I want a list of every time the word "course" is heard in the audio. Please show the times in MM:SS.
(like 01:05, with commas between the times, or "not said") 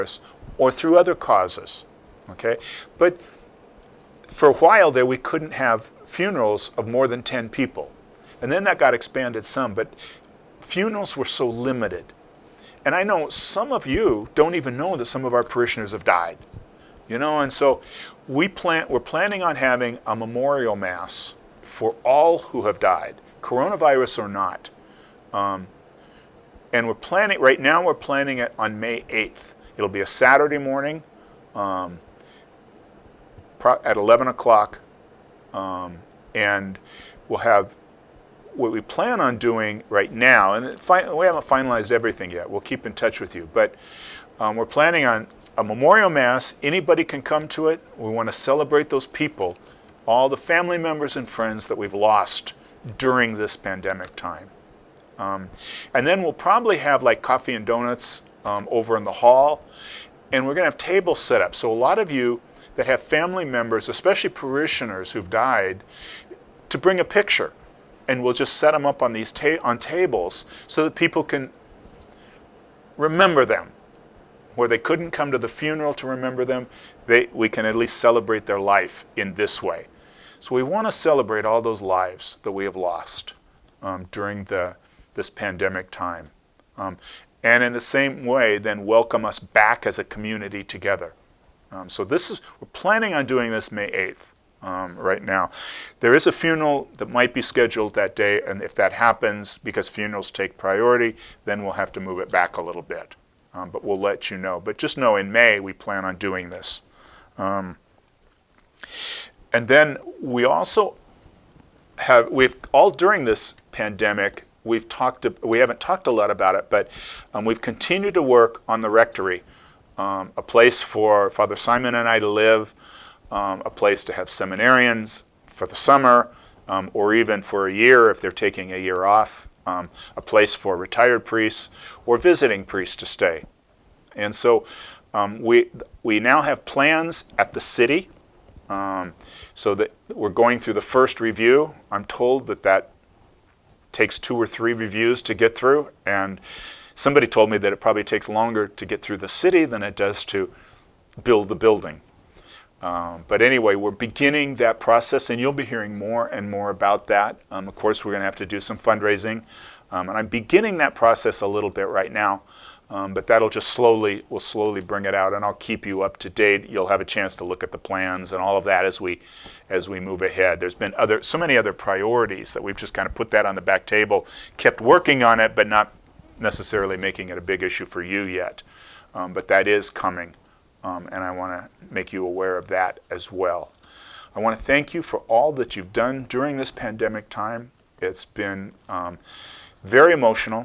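02:37.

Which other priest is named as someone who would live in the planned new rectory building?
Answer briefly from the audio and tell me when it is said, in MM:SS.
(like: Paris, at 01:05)
Father Simon, at 02:01.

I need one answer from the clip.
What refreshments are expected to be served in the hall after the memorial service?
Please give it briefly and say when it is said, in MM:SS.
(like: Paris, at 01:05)
Coffee and donuts, at 00:57.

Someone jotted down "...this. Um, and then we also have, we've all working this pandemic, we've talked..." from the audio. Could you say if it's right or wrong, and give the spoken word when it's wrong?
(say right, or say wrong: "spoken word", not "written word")
wrong: "during", not "working".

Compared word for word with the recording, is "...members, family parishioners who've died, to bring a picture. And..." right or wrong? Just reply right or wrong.
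wrong.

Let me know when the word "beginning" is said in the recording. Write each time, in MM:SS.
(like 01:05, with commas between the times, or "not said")
02:33, 02:40.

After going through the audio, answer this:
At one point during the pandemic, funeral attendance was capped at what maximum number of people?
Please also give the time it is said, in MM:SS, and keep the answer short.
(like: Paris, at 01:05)
10, at 00:07.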